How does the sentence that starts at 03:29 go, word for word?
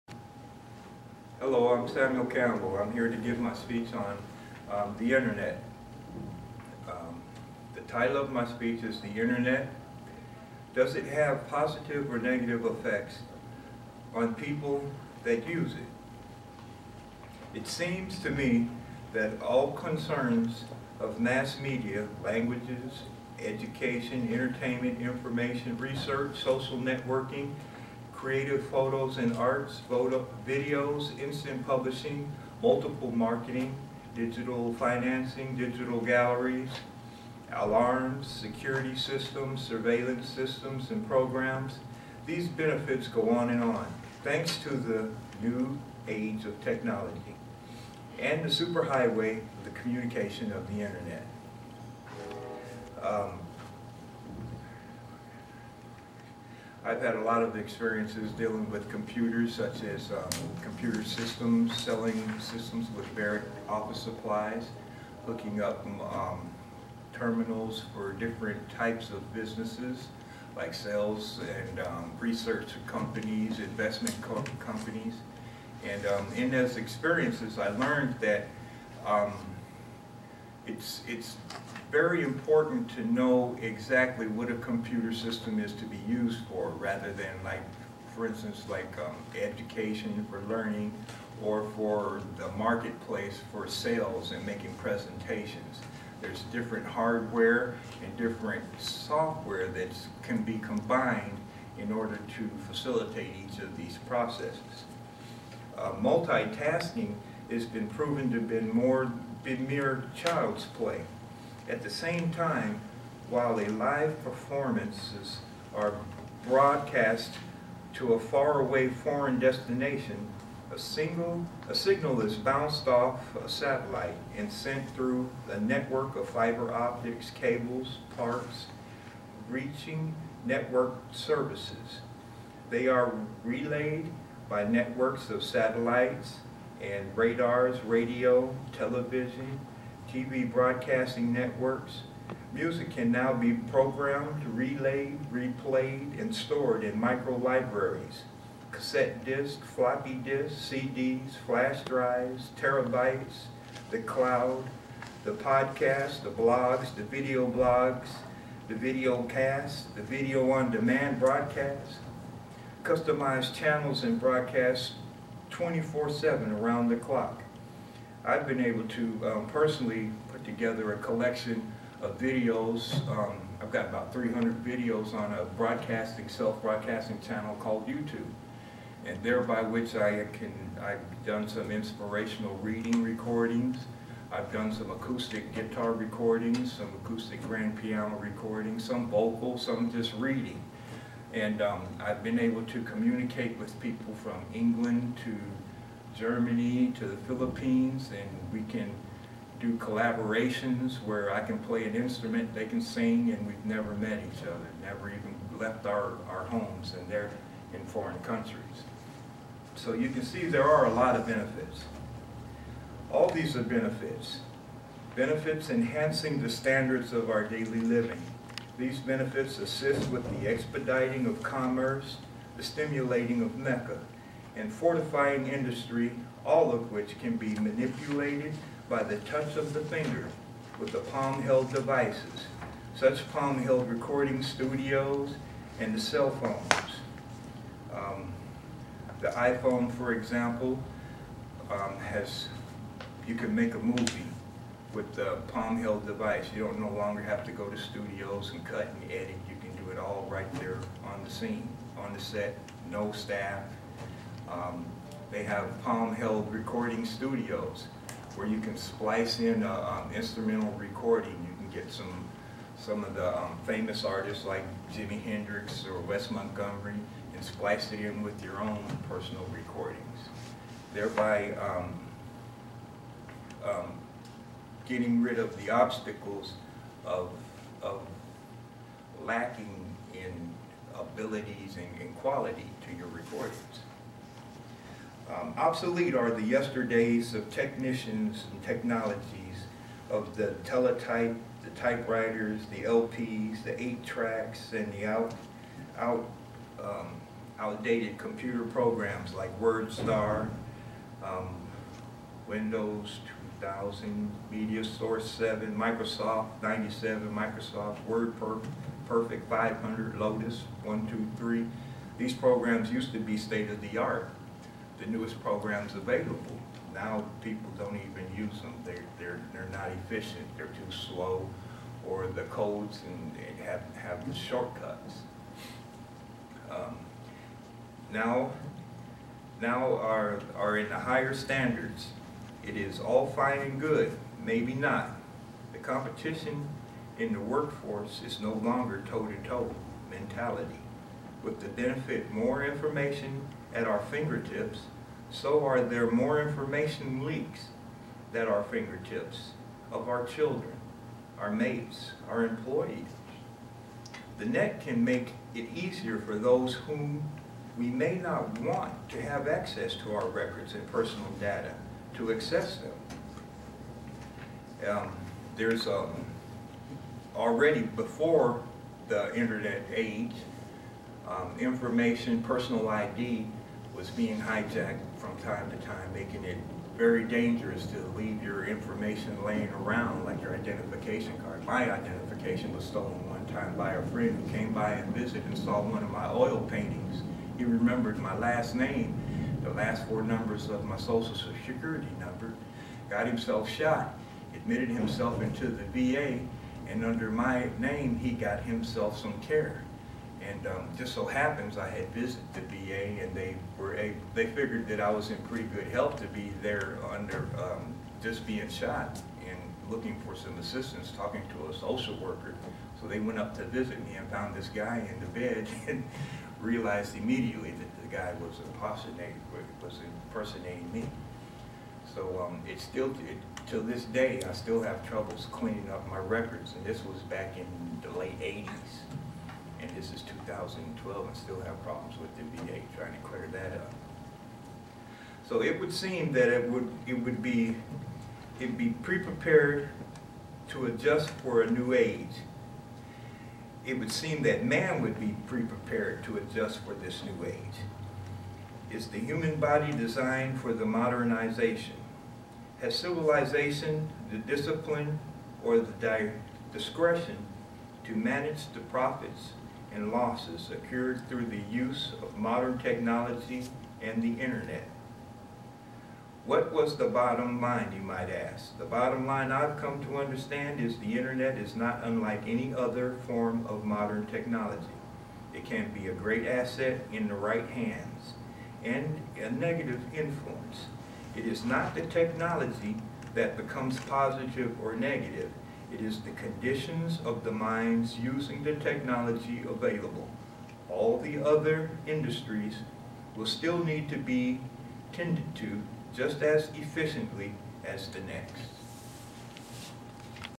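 So you can see there are a lot of benefits.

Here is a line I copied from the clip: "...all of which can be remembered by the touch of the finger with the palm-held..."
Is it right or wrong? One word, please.
wrong.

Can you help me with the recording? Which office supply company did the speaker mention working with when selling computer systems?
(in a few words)
Barrett office supplies.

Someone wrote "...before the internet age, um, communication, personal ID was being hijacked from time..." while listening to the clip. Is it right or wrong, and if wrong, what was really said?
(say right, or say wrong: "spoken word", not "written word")
wrong: "information", not "communication".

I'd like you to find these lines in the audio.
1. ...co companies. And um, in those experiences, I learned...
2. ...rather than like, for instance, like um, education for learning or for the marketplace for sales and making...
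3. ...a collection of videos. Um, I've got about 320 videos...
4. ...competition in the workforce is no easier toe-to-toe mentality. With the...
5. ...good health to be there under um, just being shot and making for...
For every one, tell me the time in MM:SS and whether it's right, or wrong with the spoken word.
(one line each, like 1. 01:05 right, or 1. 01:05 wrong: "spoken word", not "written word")
1. 01:14 right
2. 01:26 right
3. 02:50 wrong: "300", not "320"
4. 05:35 wrong: "longer", not "easier"
5. 06:45 wrong: "looking", not "making".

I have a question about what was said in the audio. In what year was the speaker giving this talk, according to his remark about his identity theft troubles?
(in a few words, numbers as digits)
2012.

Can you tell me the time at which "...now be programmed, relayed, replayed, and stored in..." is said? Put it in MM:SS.
02:23.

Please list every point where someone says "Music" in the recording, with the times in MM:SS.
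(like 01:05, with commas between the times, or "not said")
02:22.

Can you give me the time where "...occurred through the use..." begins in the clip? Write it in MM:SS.
07:40.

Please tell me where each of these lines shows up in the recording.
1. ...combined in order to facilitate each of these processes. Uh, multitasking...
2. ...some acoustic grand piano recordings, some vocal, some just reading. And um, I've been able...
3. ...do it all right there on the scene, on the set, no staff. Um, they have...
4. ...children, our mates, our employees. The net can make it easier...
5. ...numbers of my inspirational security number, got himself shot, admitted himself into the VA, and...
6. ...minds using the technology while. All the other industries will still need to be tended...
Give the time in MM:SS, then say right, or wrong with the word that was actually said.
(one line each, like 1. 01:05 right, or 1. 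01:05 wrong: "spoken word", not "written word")
1. 01:40 right
2. 03:06 right
3. 04:09 right
4. 05:50 right
5. 06:30 wrong: "social", not "inspirational"
6. 08:07 wrong: "available", not "while".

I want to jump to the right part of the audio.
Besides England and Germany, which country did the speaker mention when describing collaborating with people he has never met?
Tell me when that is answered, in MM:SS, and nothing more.
03:17.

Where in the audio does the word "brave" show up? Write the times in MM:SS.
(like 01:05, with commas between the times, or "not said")
not said.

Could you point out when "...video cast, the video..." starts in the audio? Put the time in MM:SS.
02:38.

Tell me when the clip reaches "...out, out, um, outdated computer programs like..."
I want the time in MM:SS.
04:55.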